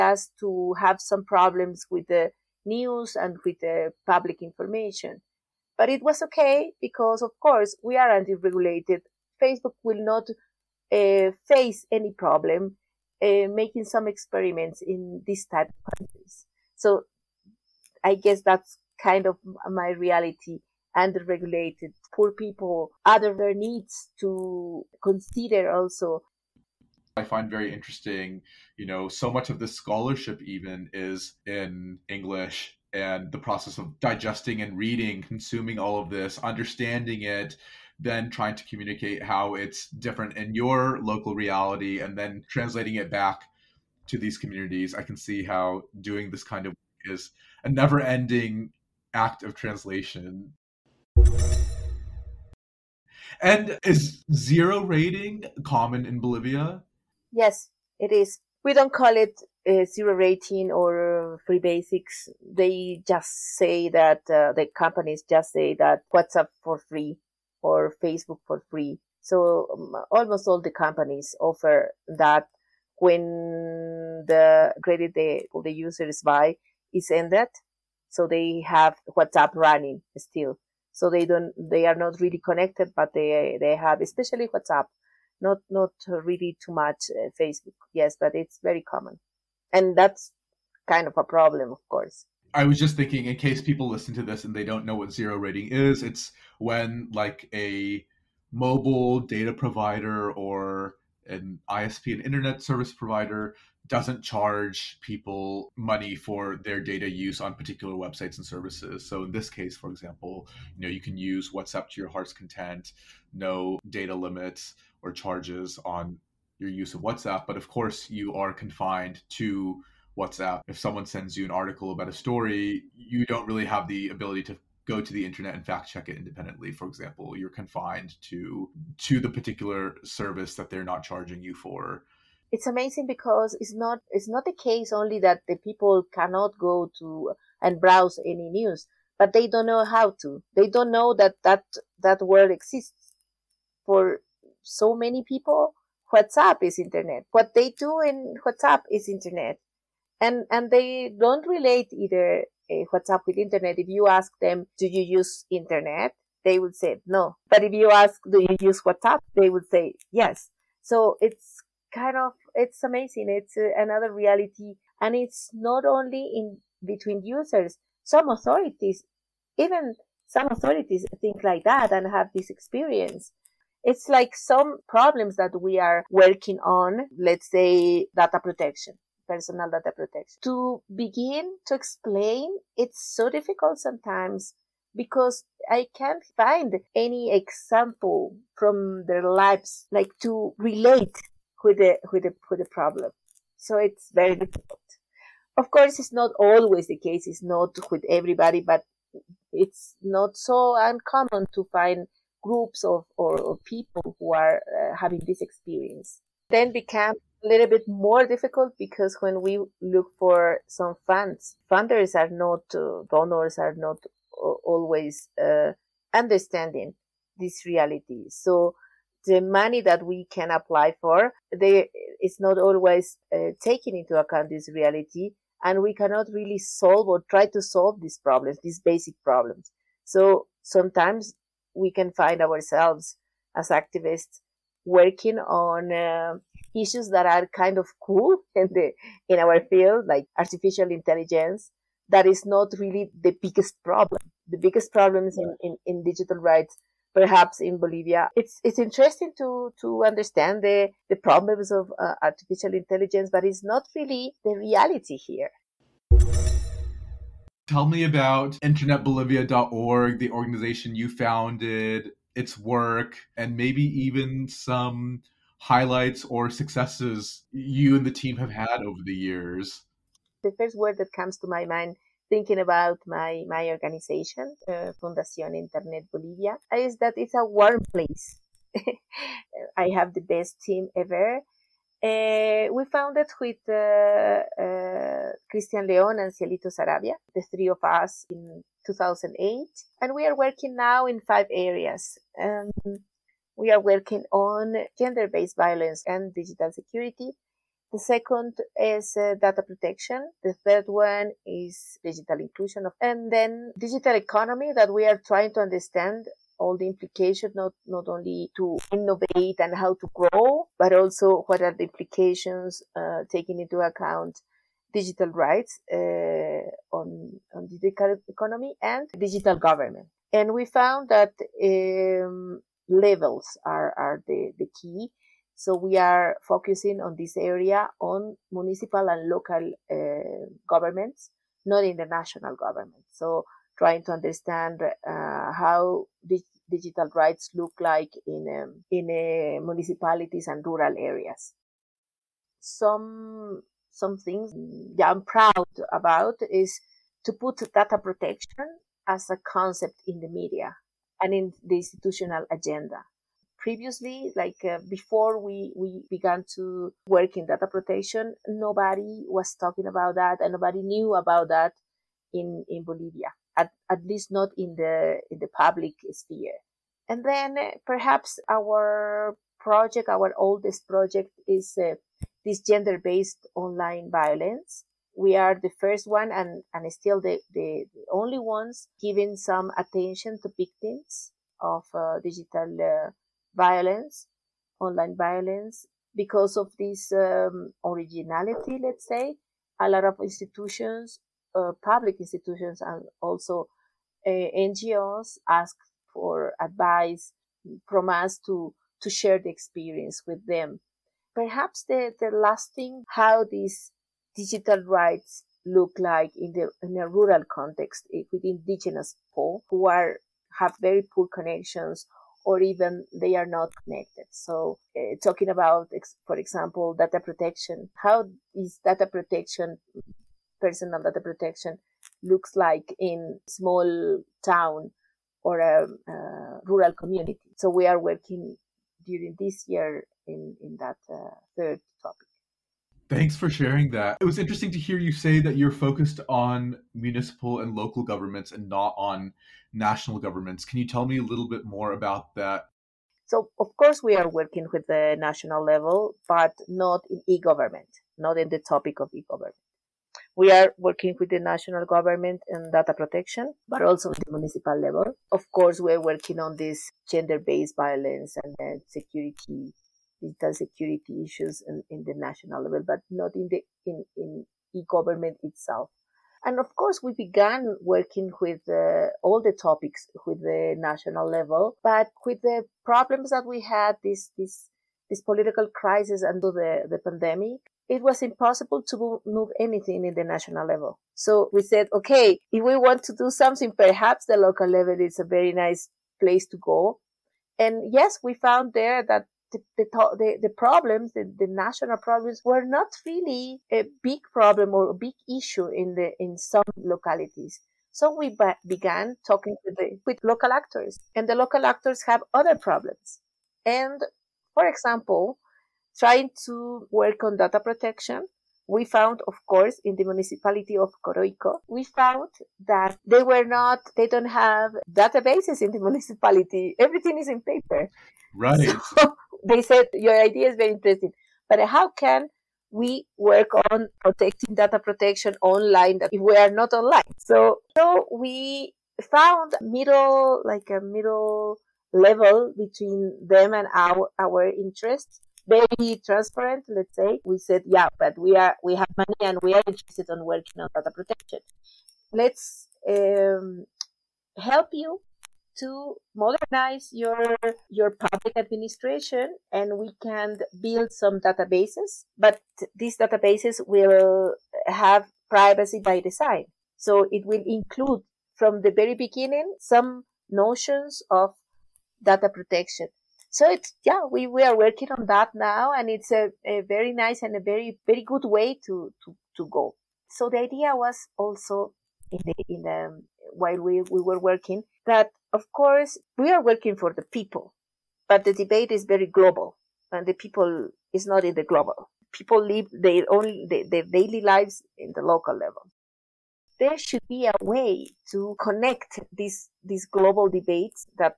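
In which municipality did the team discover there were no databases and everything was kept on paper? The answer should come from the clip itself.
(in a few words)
Coroico.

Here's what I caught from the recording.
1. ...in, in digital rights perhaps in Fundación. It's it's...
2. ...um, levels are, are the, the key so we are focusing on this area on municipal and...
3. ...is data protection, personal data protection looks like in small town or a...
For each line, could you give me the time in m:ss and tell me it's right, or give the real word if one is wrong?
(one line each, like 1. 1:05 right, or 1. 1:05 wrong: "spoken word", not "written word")
1. 4:05 wrong: "Bolivia", not "Fundación"
2. 5:21 right
3. 6:58 right.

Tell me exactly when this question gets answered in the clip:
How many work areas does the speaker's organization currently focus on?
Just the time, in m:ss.
4:51.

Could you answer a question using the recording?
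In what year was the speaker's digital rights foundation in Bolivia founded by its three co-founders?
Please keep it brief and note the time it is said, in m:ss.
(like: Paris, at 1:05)
2008, at 4:48.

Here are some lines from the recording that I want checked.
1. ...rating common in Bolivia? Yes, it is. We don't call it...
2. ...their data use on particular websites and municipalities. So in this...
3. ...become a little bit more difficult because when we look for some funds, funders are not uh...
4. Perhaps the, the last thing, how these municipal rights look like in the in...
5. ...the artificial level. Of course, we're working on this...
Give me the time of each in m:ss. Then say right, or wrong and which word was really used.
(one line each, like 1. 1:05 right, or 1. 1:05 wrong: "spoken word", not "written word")
1. 0:54 right
2. 1:46 wrong: "services", not "municipalities"
3. 3:26 right
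4. 6:41 wrong: "digital", not "municipal"
5. 7:34 wrong: "municipal", not "artificial".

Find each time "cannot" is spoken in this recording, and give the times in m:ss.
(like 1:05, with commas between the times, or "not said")
2:16, 3:45.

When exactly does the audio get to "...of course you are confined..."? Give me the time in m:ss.
1:57.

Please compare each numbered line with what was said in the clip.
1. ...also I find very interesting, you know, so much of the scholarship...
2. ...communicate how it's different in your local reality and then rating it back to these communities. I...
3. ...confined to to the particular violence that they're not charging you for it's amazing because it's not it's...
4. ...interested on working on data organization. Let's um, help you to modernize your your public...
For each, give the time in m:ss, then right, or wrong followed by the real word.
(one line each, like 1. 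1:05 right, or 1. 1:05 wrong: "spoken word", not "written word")
1. 0:25 right
2. 0:38 wrong: "translating", not "rating"
3. 2:07 wrong: "service", not "violence"
4. 8:59 wrong: "protection", not "organization".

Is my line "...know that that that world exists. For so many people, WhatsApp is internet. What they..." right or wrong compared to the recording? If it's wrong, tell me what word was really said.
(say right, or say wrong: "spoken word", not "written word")
right.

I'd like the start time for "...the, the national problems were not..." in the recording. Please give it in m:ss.
8:11.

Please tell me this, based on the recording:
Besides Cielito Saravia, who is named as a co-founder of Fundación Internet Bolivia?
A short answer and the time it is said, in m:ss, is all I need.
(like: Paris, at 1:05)
Cristian León, at 4:45.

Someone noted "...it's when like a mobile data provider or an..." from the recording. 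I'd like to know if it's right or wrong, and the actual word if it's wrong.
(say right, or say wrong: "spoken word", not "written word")
right.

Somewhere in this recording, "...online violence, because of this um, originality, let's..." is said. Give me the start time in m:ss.
6:24.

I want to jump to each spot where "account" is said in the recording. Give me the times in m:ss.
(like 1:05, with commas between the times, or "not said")
3:44, 5:13.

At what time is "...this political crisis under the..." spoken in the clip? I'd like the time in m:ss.
7:55.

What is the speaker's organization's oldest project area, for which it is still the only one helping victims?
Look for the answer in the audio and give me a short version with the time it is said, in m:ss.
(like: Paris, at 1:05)
gender-based online violence, at 6:12.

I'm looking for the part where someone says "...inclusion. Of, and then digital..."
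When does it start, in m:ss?
5:02.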